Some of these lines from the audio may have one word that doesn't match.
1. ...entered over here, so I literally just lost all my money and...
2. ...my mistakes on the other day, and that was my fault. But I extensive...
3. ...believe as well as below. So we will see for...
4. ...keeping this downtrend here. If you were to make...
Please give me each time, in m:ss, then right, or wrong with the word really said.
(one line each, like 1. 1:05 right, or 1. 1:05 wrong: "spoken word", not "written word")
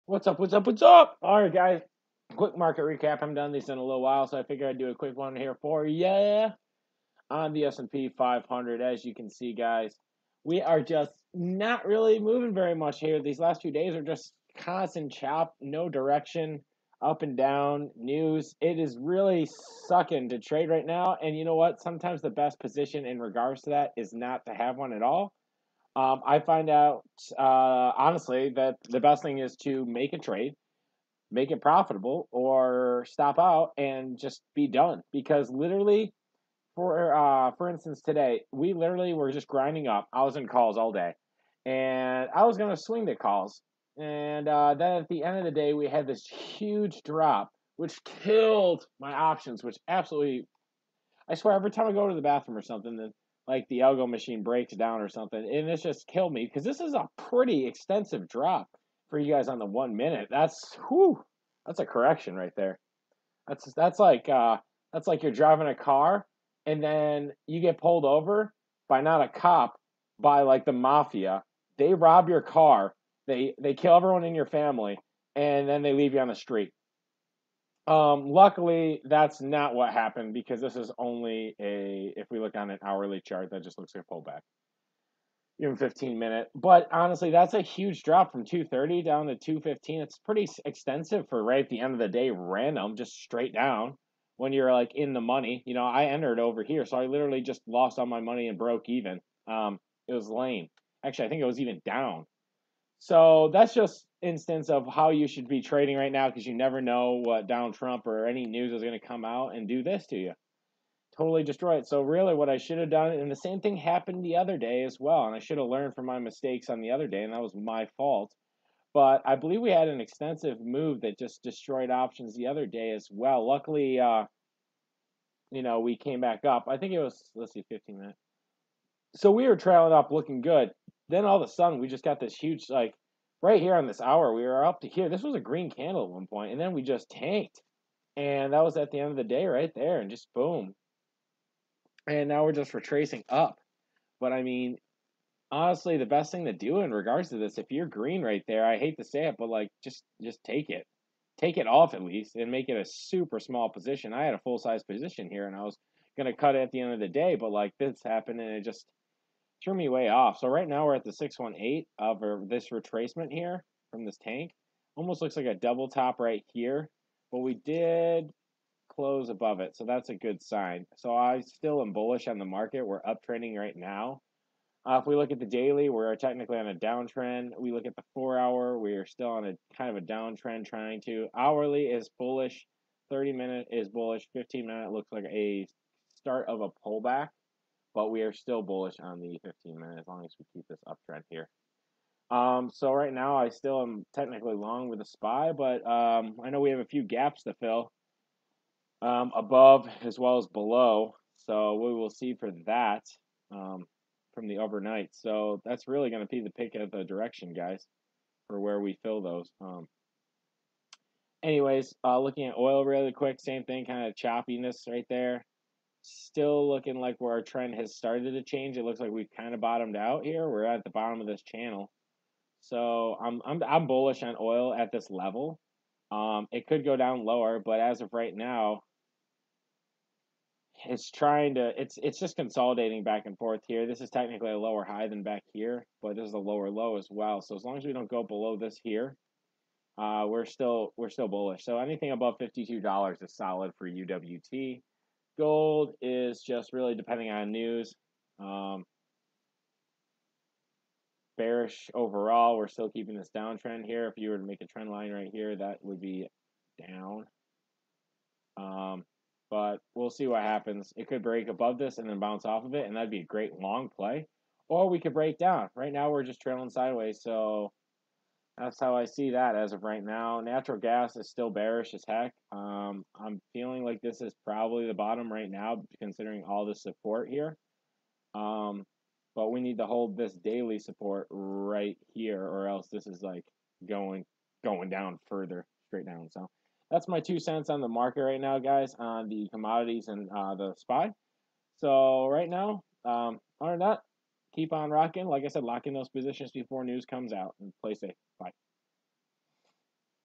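1. 1:36 right
2. 1:56 wrong: "believe", not "extensive"
3. 3:19 wrong: "above", not "believe"
4. 4:12 right.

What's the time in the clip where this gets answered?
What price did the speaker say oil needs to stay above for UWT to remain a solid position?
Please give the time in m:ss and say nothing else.
4:02.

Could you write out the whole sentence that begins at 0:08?
As you can see, guys, we are just not really moving very much here.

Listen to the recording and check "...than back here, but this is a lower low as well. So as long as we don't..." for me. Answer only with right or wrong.
right.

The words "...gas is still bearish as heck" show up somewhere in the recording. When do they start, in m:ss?
4:30.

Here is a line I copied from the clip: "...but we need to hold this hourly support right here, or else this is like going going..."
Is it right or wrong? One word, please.
wrong.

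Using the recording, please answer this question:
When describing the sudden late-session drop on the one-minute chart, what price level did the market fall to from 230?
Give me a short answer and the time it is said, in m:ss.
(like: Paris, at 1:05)
215, at 1:29.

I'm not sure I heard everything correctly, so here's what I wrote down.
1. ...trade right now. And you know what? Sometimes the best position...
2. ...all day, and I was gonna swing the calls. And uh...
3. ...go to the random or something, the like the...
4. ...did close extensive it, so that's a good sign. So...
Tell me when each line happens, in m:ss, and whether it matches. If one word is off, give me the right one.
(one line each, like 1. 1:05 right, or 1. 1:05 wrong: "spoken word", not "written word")
1. 0:20 right
2. 0:40 right
3. 0:51 wrong: "bathroom", not "random"
4. 2:47 wrong: "above", not "extensive".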